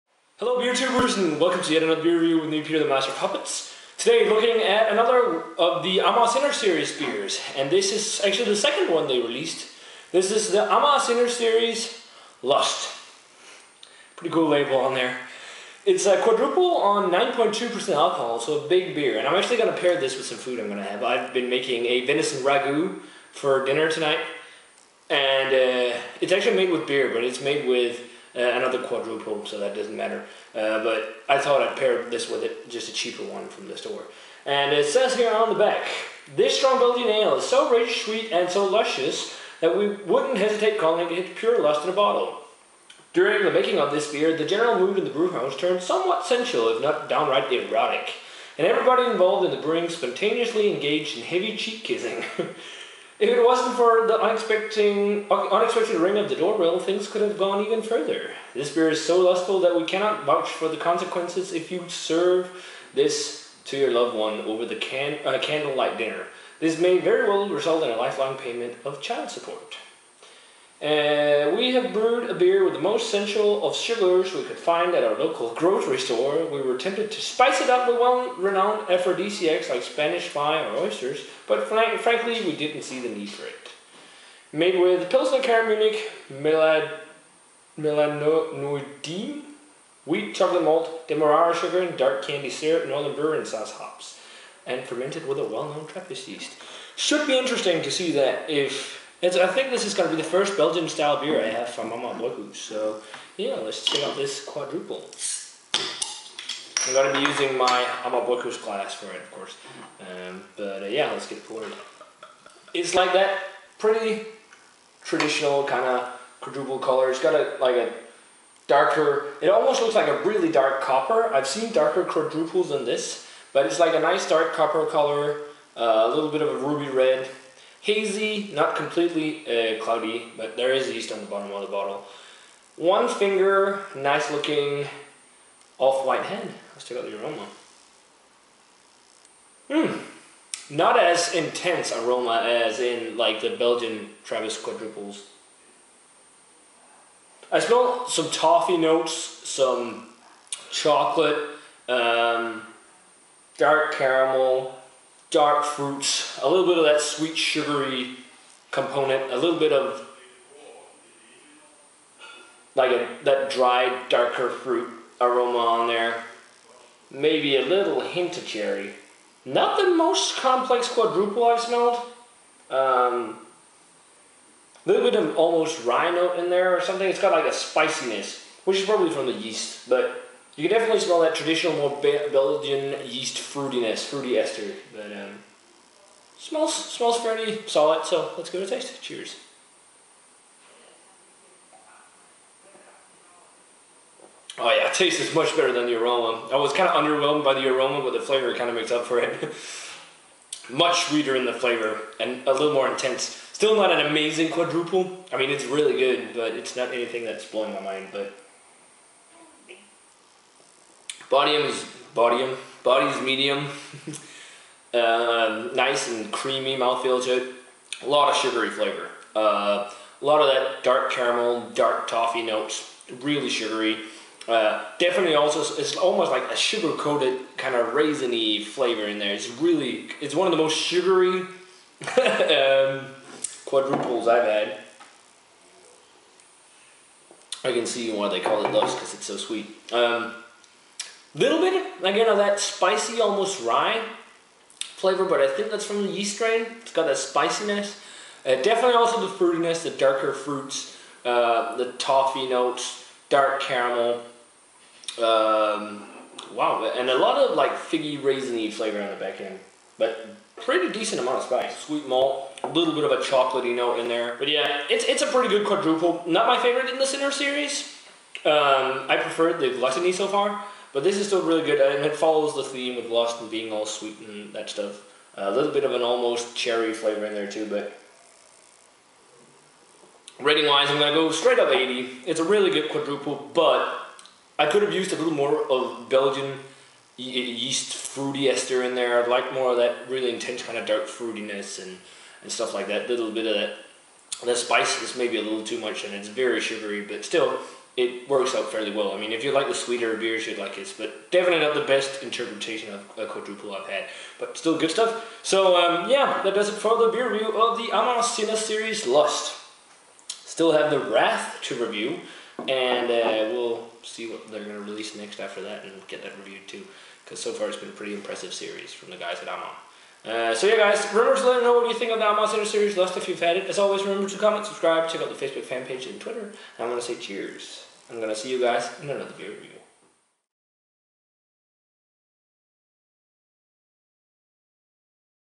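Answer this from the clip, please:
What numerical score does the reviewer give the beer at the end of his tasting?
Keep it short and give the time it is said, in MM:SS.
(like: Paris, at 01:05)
80, at 04:41.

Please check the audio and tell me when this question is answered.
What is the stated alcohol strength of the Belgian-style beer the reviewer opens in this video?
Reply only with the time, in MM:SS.
00:17.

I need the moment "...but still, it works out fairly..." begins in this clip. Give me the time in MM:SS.
04:57.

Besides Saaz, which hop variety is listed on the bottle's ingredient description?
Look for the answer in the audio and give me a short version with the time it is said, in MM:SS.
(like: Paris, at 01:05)
Northern Brewer, at 01:32.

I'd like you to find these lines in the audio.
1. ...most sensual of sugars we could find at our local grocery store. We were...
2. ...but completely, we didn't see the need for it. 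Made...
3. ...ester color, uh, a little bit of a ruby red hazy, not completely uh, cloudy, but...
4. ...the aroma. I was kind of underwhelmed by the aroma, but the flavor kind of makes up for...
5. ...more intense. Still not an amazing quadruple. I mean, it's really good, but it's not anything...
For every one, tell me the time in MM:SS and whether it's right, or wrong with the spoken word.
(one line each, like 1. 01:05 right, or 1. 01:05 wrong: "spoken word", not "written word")
1. 01:12 right
2. 01:21 wrong: "frankly", not "completely"
3. 02:04 wrong: "copper", not "ester"
4. 03:15 right
5. 03:22 right.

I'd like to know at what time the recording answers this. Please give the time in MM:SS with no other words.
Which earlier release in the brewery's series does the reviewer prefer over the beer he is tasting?
04:29.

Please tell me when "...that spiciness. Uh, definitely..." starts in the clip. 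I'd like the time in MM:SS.
04:07.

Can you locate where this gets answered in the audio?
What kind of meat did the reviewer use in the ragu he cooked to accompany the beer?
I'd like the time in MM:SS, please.
00:22.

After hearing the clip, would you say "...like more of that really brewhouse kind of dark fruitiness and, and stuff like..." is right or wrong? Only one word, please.
wrong.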